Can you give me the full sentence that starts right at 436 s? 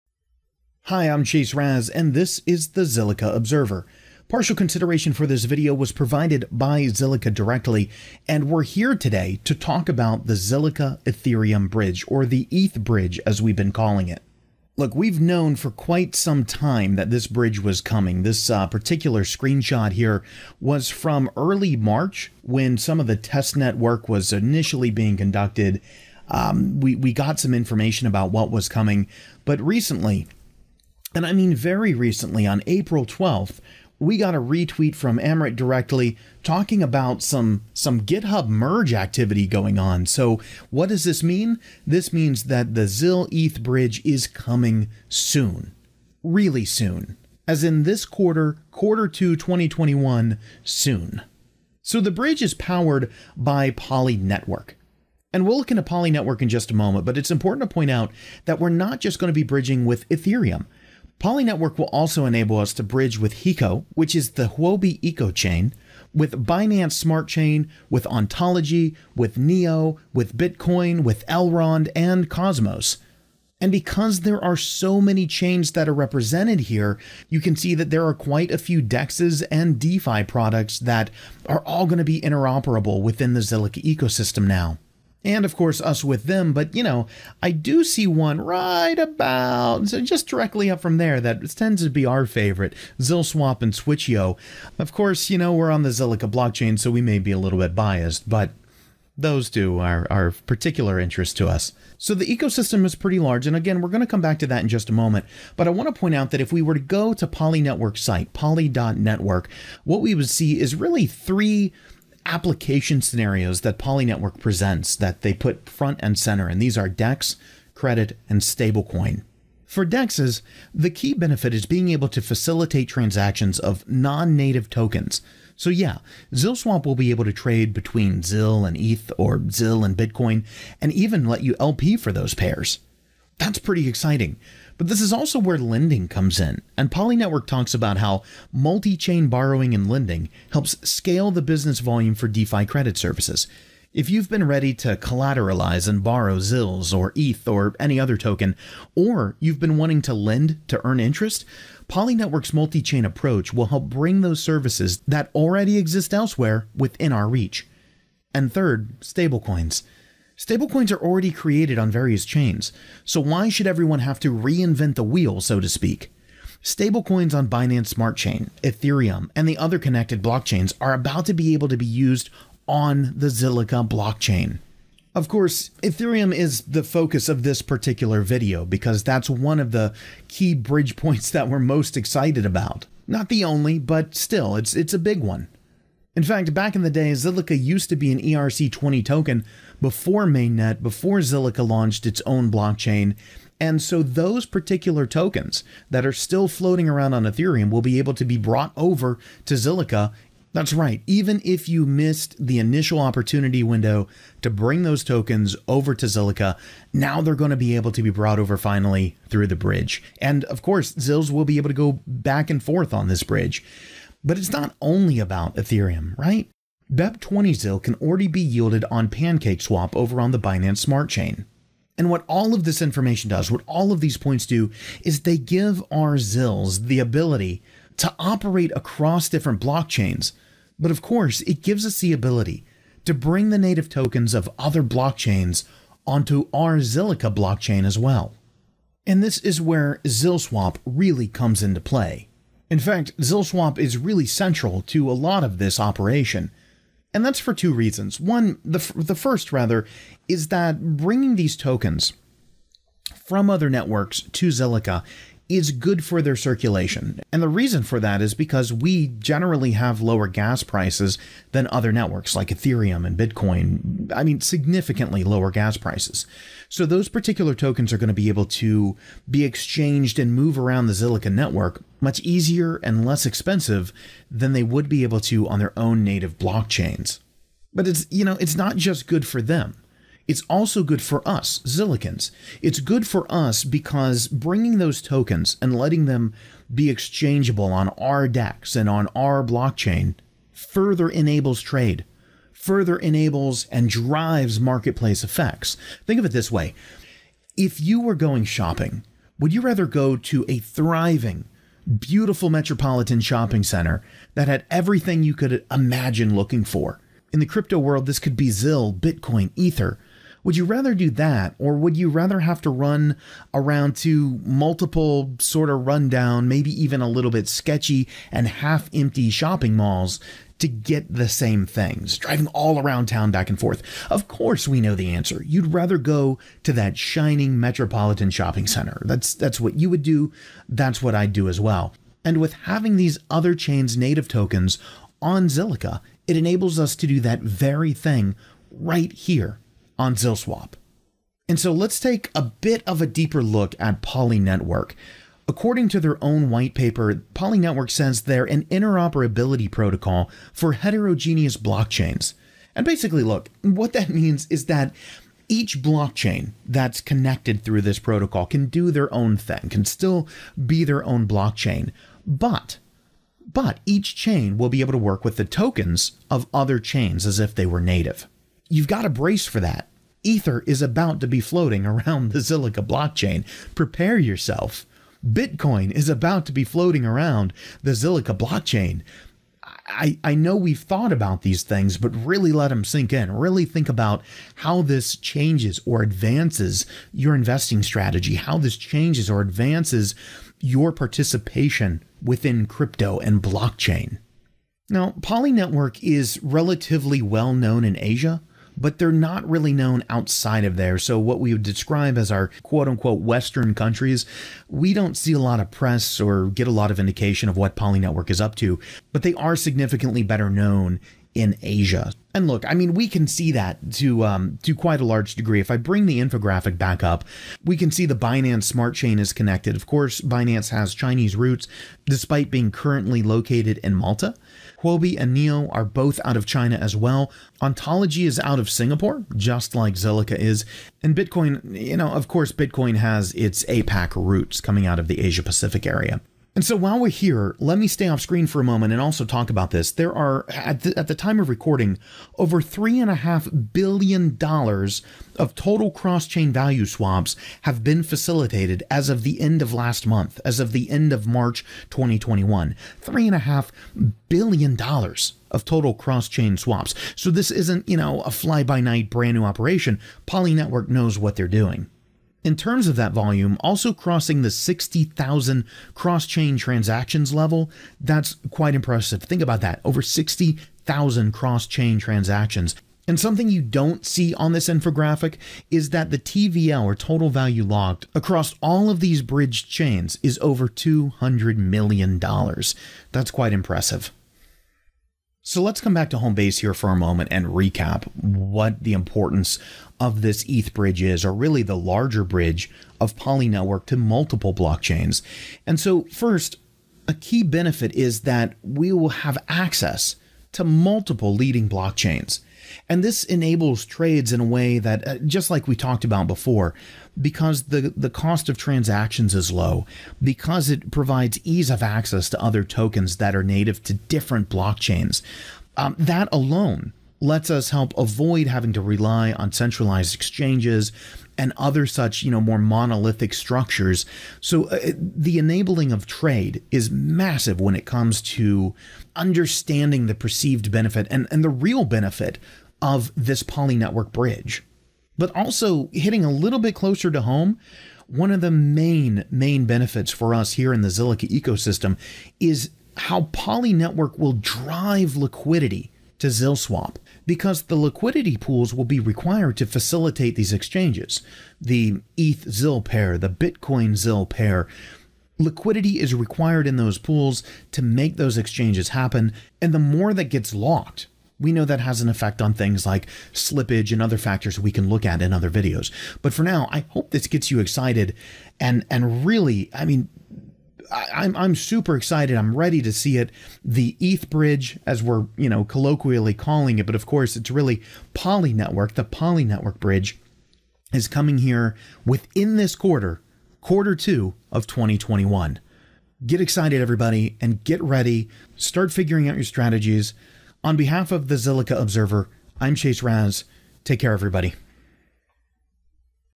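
And so while we're here, let me stay off screen for a moment and also talk about this.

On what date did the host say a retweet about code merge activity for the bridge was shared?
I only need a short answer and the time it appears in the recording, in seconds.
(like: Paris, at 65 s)
April 12th, at 32 s.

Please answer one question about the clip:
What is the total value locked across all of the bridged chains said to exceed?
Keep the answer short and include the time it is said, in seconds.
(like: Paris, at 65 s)
$200 million, at 480 s.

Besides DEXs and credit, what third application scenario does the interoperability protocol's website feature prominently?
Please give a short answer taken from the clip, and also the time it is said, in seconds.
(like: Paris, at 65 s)
stablecoin, at 118 s.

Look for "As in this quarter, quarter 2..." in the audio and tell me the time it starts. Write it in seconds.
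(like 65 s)
47 s.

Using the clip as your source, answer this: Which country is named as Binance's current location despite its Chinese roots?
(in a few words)
Malta.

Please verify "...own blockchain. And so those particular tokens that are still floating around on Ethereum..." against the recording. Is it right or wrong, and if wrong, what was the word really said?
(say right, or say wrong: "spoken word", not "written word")
right.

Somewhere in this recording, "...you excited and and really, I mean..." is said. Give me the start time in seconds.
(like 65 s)
567 s.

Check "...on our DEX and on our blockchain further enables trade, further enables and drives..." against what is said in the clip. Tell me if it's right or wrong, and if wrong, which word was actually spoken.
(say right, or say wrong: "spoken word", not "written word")
right.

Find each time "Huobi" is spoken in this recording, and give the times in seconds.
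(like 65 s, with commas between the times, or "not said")
64 s, 424 s.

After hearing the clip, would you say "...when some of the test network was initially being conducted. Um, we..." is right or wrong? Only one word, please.
right.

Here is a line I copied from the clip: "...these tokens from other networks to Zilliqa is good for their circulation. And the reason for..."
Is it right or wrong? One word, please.
right.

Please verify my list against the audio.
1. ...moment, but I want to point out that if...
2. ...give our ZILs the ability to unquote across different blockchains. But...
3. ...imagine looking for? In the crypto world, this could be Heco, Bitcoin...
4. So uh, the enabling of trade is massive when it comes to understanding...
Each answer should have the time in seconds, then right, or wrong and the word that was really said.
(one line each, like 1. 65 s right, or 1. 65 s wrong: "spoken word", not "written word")
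1. 104 s right
2. 225 s wrong: "operate", not "unquote"
3. 305 s wrong: "ZIL", not "Heco"
4. 524 s right.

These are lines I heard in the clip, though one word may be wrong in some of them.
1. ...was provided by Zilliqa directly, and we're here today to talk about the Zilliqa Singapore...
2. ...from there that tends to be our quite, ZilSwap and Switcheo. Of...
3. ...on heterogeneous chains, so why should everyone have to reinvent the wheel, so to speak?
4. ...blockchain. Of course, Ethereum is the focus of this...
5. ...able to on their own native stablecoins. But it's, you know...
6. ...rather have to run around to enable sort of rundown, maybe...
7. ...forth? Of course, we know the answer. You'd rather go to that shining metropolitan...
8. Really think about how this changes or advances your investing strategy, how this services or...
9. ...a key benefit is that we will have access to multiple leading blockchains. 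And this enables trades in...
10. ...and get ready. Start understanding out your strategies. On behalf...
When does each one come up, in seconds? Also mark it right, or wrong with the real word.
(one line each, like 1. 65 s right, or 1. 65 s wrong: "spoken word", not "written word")
1. 5 s wrong: "Ethereum", not "Singapore"
2. 90 s wrong: "favorite", not "quite"
3. 161 s wrong: "various", not "heterogeneous"
4. 173 s right
5. 275 s wrong: "blockchains", not "stablecoins"
6. 312 s wrong: "multiple", not "enable"
7. 323 s right
8. 383 s wrong: "changes", not "services"
9. 497 s right
10. 587 s wrong: "figuring", not "understanding".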